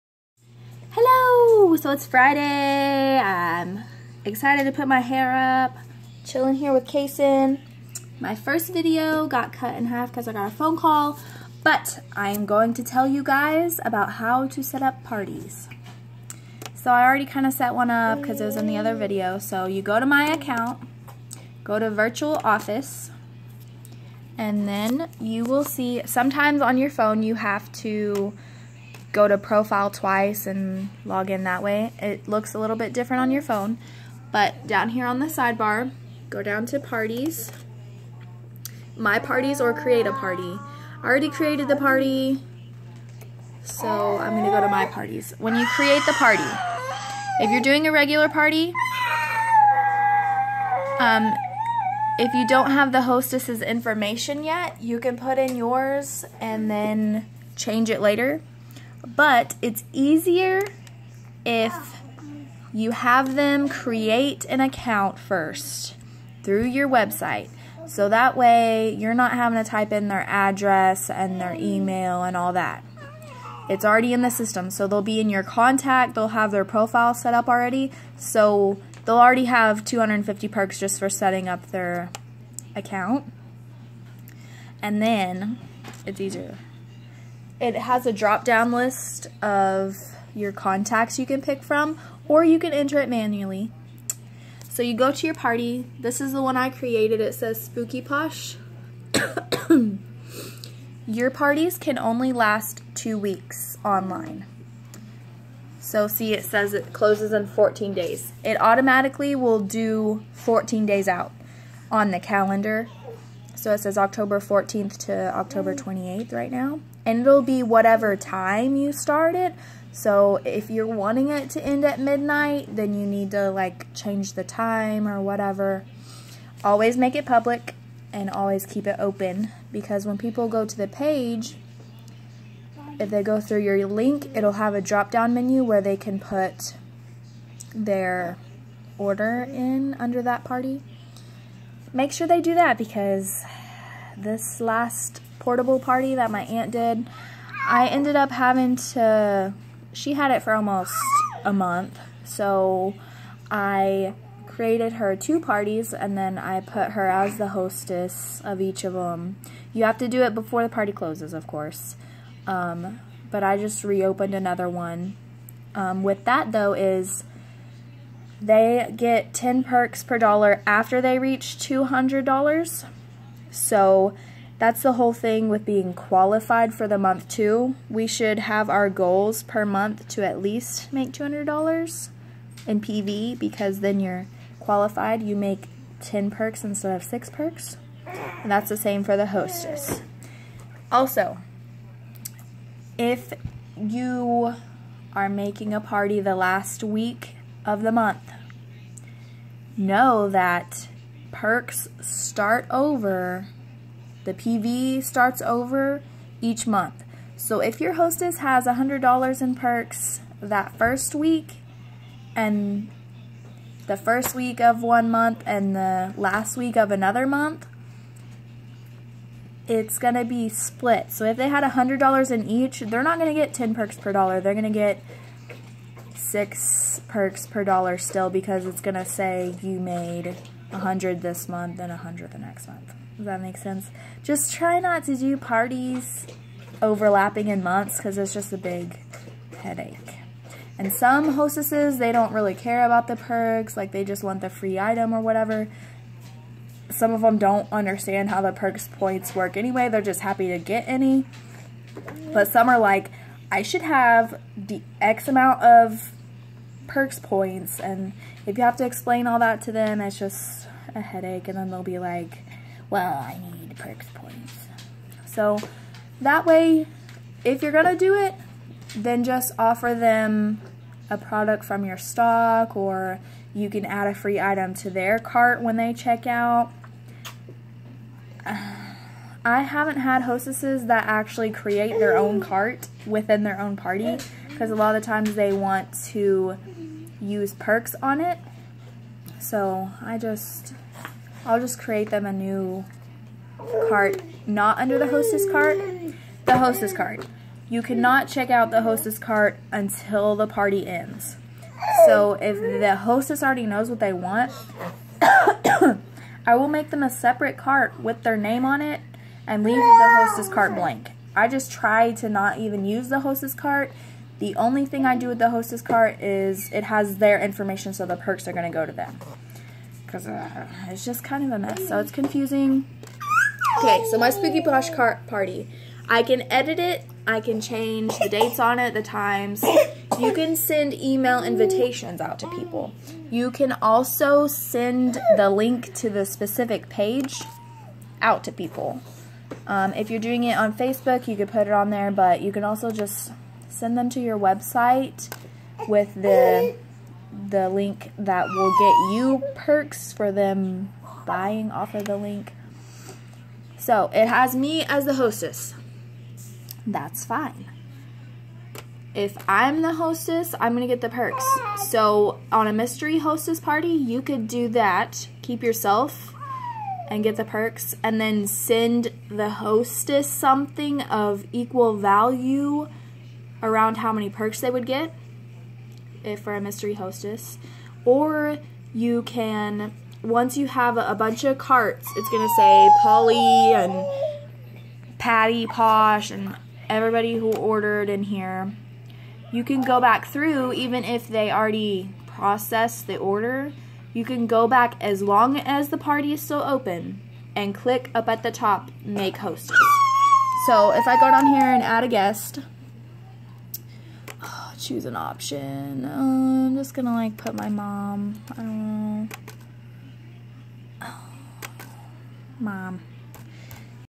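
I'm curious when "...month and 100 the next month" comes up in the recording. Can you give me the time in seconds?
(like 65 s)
231 s.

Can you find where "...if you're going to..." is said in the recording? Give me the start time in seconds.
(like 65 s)
267 s.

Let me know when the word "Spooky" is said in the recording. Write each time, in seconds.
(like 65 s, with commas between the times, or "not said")
97 s, 324 s.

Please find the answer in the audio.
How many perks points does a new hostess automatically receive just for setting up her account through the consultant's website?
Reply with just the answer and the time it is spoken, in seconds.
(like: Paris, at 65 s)
250, at 79 s.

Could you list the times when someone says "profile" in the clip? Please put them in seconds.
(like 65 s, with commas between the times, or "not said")
29 s, 76 s.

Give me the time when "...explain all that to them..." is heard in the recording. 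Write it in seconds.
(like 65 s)
258 s.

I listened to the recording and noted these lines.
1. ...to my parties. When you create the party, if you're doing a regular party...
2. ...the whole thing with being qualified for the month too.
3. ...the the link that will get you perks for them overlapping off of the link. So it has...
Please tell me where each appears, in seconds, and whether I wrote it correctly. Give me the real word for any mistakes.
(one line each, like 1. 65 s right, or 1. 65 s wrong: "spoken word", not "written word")
1. 44 s right
2. 174 s right
3. 346 s wrong: "buying", not "overlapping".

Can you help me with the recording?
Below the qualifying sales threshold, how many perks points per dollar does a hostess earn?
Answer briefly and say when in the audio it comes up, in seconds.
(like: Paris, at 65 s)
6, at 187 s.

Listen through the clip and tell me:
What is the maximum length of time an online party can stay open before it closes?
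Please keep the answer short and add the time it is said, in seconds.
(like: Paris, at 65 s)
2 weeks, at 102 s.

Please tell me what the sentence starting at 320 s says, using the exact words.
Because uh, it's just kind of a mess, so it's confusing.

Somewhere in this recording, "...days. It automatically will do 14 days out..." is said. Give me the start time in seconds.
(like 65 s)
107 s.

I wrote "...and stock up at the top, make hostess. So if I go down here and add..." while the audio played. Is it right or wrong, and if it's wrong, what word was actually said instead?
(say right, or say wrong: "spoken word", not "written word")
wrong: "click", not "stock".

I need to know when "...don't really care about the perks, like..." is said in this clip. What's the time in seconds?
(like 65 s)
242 s.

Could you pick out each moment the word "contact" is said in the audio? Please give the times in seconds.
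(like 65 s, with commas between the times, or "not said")
75 s, 90 s.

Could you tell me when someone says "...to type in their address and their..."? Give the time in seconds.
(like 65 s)
69 s.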